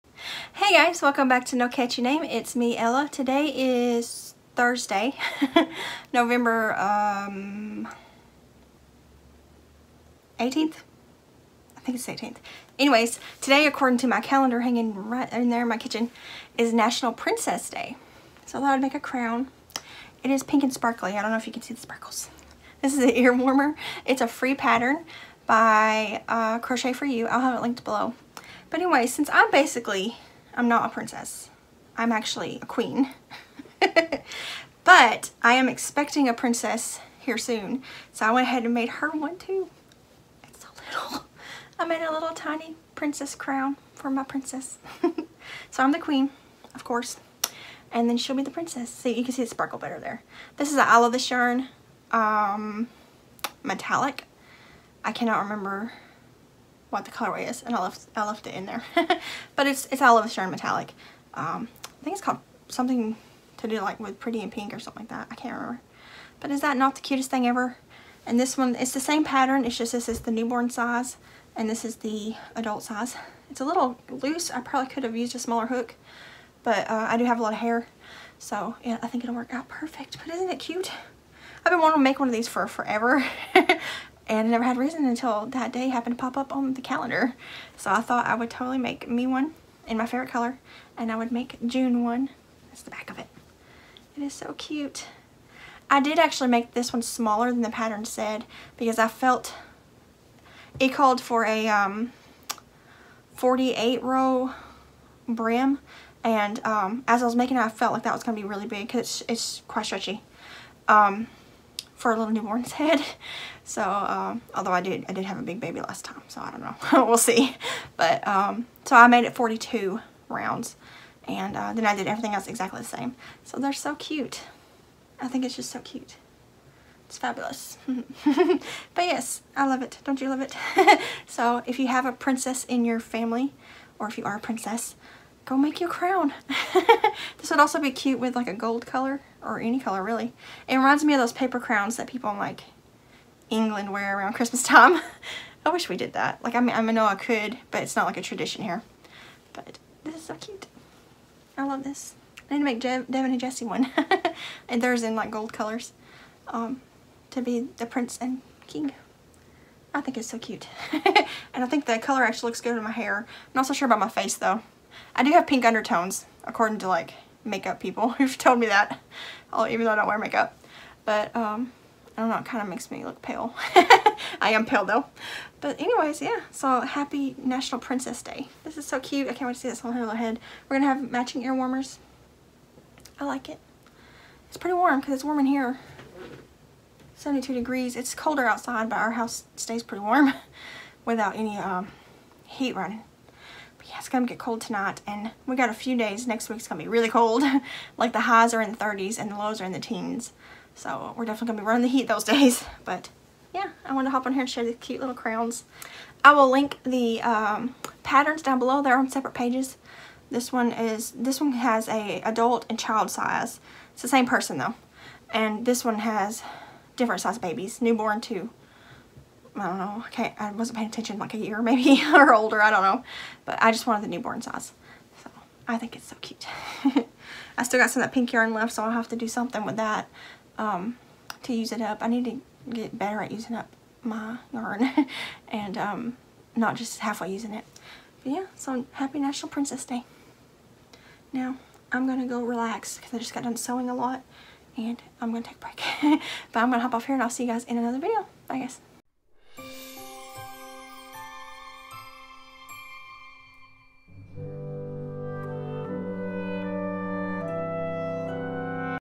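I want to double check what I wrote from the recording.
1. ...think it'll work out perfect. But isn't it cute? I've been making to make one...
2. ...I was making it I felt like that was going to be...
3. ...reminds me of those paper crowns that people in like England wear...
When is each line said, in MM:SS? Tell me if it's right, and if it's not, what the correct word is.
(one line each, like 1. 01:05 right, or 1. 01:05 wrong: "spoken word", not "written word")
1. 01:19 wrong: "wanting", not "making"
2. 01:47 right
3. 02:20 right.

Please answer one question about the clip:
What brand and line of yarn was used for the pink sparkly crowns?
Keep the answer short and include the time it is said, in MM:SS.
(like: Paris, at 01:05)
I Love This Yarn, at 00:50.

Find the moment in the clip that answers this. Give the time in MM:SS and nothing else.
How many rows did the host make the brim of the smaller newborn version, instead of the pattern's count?
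01:59.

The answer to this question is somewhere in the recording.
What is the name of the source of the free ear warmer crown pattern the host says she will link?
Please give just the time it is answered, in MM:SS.
00:26.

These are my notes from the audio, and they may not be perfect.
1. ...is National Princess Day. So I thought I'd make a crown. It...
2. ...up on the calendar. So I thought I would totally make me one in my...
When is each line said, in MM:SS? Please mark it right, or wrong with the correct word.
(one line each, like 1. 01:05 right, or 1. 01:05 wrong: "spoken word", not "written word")
1. 00:16 right
2. 01:26 right.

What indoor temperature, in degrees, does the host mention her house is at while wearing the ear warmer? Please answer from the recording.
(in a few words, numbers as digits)
72 degrees.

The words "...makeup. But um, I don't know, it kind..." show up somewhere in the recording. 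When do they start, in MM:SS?
02:50.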